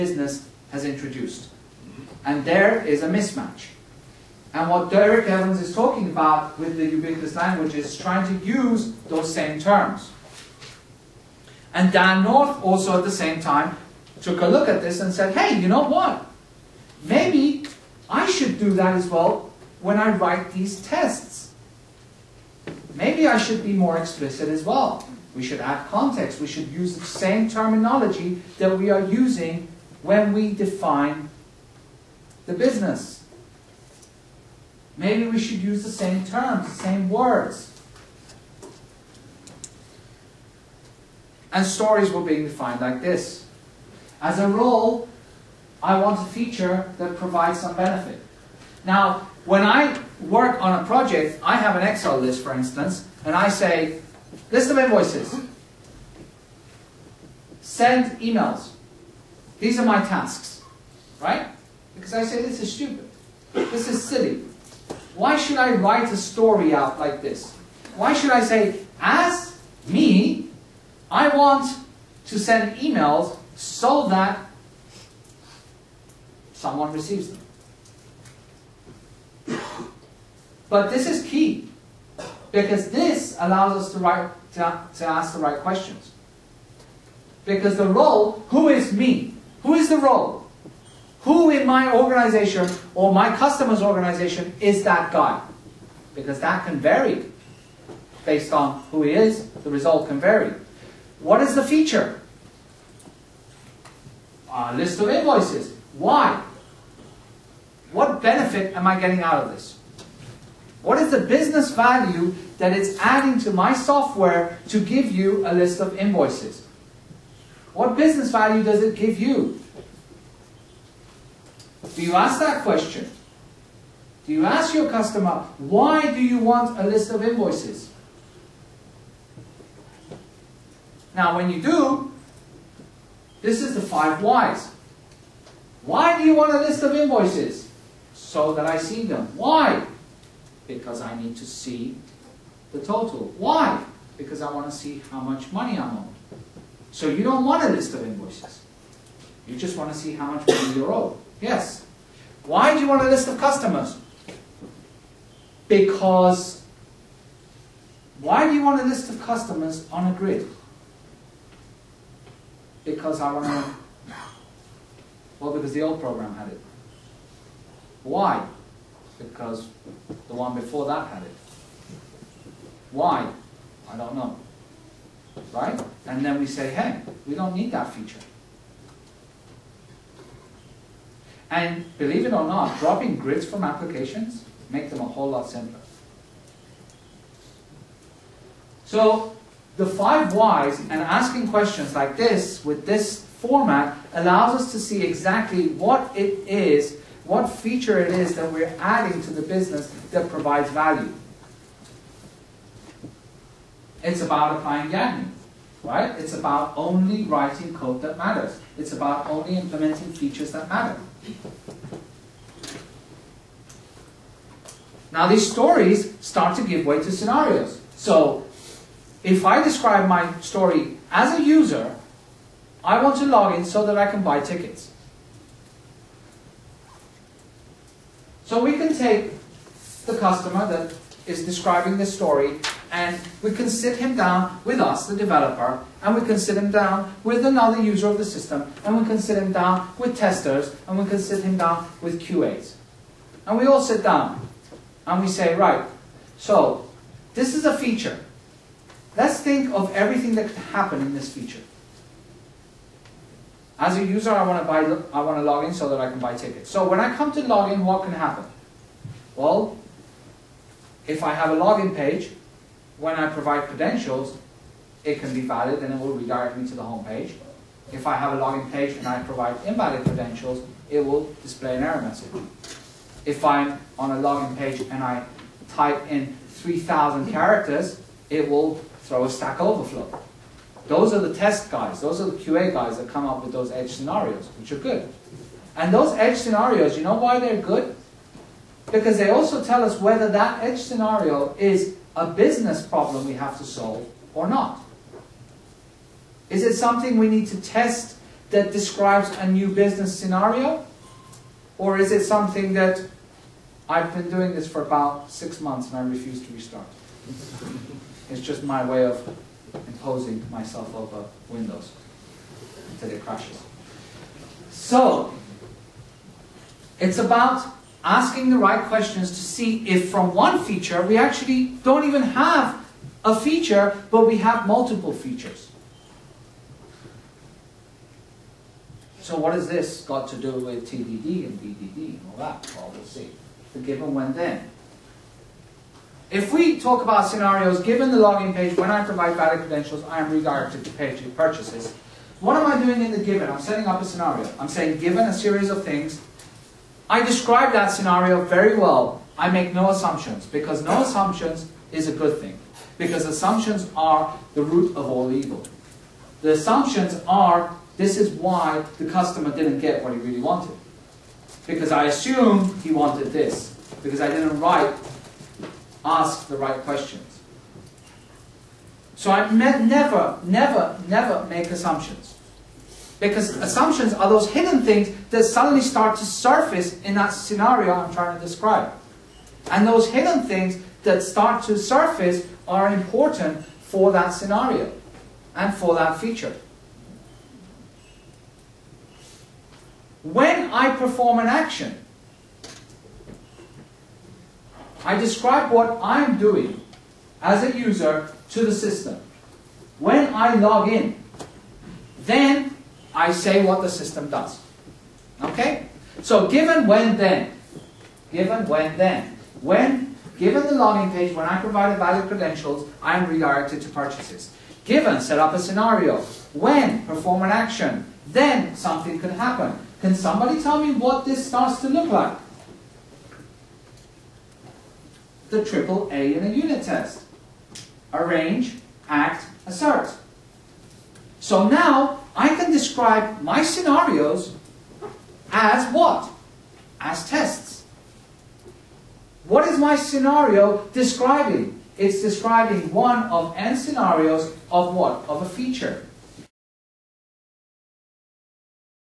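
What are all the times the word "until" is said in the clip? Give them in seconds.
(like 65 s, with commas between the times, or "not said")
312 s.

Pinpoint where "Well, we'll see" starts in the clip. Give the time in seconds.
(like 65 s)
332 s.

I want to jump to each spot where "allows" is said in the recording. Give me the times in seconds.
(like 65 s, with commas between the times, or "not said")
83 s, 194 s.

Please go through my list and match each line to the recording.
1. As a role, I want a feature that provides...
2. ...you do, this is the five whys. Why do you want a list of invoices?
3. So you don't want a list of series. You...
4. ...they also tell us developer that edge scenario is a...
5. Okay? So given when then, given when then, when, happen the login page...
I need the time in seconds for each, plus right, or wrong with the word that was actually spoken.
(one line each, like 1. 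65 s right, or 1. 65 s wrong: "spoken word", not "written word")
1. 44 s right
2. 131 s right
3. 146 s wrong: "invoices", not "series"
4. 289 s wrong: "whether", not "developer"
5. 405 s wrong: "given", not "happen".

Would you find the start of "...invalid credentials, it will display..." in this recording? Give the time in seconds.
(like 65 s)
269 s.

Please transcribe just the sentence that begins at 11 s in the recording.
And Dan North also at the same time took a look at this and said, hey, you know what?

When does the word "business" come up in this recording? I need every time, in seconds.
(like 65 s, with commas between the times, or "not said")
32 s, 111 s, 117 s, 199 s, 292 s, 299 s.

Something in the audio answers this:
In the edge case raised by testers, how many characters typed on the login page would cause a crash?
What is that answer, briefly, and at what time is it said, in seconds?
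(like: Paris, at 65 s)
3000, at 276 s.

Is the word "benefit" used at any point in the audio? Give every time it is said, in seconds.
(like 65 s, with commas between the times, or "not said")
47 s, 108 s.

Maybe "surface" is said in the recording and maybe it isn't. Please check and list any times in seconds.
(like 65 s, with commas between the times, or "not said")
376 s, 381 s.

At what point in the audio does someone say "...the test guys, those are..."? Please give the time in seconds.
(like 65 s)
281 s.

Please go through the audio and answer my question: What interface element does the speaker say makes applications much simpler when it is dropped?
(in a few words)
grids.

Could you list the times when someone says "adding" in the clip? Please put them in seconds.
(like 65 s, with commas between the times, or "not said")
112 s, 198 s.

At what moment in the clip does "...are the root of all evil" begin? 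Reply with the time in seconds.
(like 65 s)
353 s.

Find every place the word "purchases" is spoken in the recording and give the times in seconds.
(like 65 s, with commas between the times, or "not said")
341 s, 413 s.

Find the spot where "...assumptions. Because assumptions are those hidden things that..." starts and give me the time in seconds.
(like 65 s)
371 s.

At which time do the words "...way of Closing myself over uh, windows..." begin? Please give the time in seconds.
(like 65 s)
308 s.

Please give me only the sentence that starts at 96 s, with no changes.
Because that can vary based on who he is, the result can vary.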